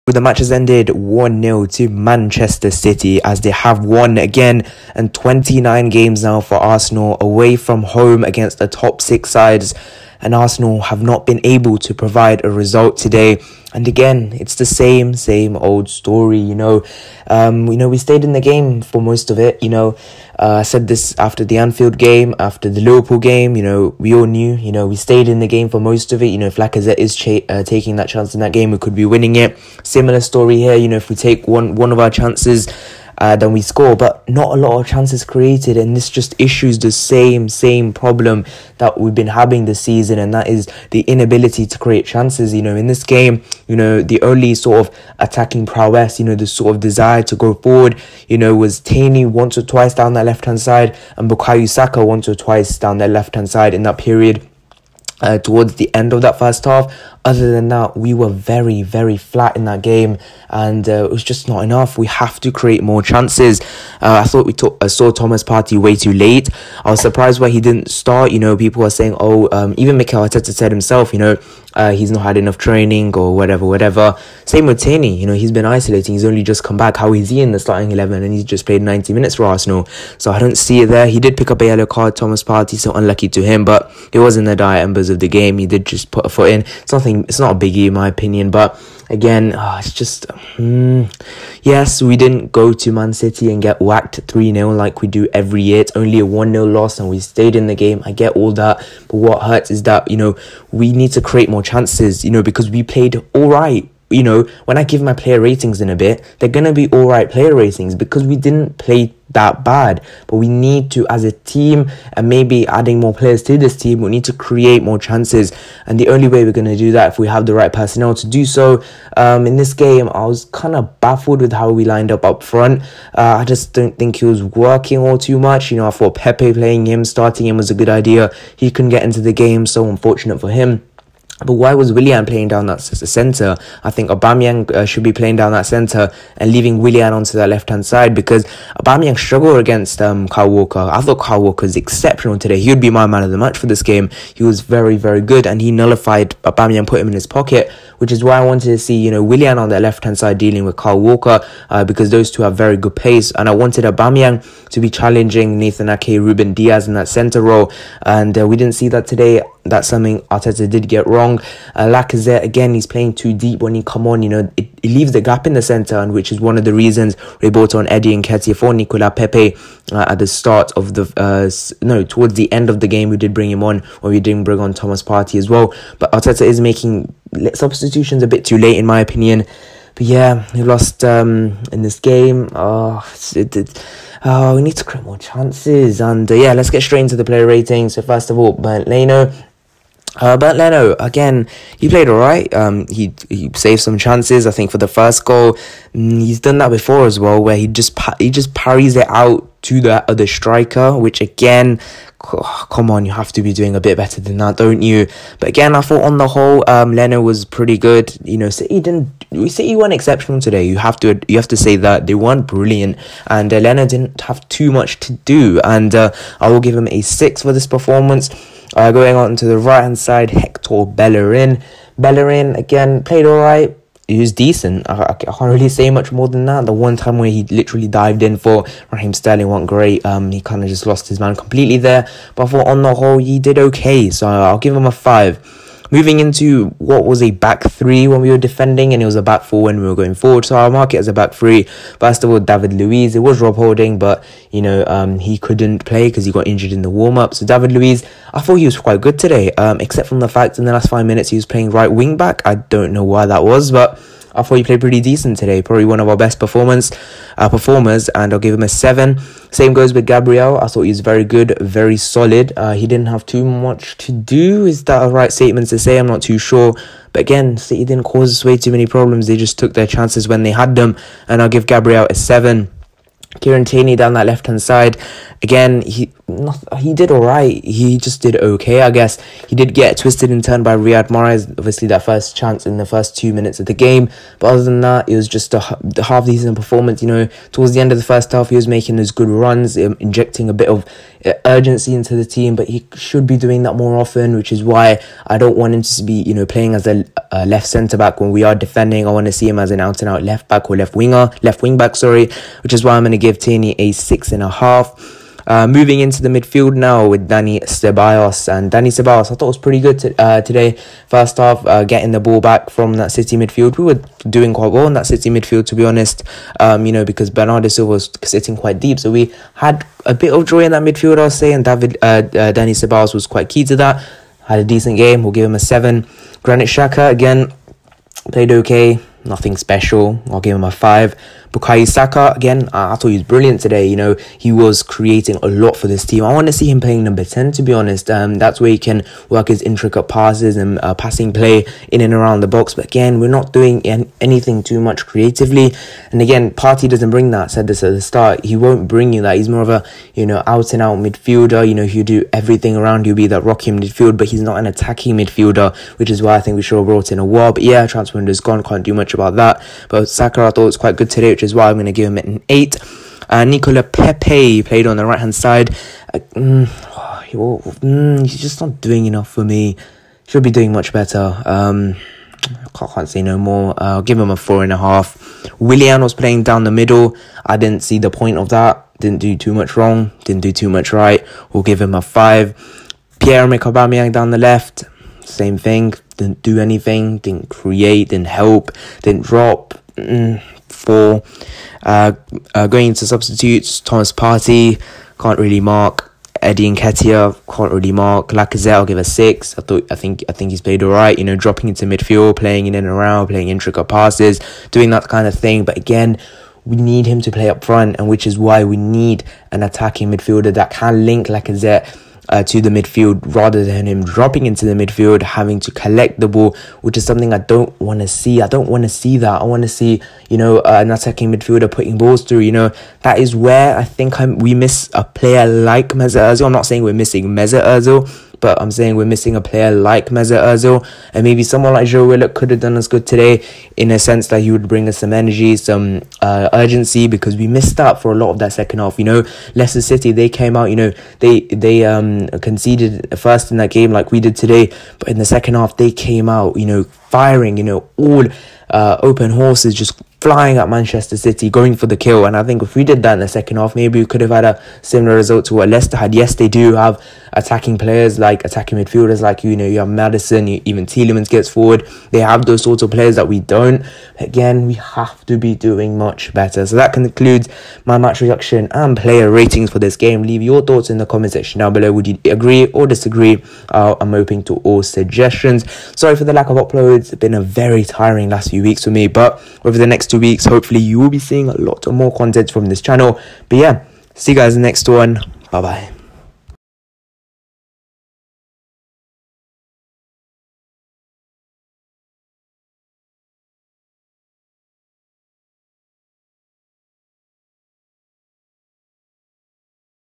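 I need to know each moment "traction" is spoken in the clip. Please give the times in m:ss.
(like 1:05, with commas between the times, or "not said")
not said.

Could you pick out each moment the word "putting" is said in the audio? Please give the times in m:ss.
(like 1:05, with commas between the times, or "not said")
7:01.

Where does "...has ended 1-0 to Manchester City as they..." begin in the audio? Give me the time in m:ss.
0:00.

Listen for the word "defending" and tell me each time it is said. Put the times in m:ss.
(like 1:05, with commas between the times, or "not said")
3:58, 4:58.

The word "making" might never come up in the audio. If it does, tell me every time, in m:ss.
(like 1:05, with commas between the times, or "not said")
2:56, 4:48.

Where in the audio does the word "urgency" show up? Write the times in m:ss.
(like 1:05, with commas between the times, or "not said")
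4:51, 7:16.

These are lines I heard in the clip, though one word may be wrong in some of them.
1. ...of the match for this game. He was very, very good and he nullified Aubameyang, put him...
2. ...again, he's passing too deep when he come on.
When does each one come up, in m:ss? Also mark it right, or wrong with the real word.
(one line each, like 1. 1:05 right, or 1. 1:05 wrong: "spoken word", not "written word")
1. 2:23 right
2. 2:42 wrong: "playing", not "passing".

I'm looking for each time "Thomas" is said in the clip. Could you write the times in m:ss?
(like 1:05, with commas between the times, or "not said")
1:05, 1:22, 2:54, 6:33.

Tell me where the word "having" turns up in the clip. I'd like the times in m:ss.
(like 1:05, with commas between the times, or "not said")
0:39, 6:55.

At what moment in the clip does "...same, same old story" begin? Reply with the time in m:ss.
0:14.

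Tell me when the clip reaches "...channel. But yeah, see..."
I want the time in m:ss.
8:02.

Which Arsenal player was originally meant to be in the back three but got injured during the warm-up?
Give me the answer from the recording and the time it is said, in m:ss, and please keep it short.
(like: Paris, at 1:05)
Rob Holding, at 4:03.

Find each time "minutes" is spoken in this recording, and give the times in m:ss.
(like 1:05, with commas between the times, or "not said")
1:19, 4:11, 4:43.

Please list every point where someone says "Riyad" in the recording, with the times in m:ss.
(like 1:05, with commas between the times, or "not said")
4:40.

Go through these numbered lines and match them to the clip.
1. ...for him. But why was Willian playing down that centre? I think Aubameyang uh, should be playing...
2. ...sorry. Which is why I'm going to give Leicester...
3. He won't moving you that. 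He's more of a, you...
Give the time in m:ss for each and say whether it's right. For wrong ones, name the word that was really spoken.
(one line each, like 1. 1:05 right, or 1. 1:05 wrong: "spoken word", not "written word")
1. 2:10 right
2. 5:01 wrong: "Tierney", not "Leicester"
3. 5:48 wrong: "bring", not "moving".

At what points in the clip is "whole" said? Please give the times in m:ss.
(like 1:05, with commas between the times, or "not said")
3:26, 3:52.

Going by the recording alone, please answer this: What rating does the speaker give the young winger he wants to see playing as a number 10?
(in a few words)
8.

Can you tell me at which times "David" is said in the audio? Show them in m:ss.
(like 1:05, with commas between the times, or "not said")
4:02, 4:07, 5:21.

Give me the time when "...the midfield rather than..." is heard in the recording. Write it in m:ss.
6:52.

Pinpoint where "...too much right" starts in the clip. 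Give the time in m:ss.
6:20.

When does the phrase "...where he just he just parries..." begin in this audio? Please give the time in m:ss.
3:17.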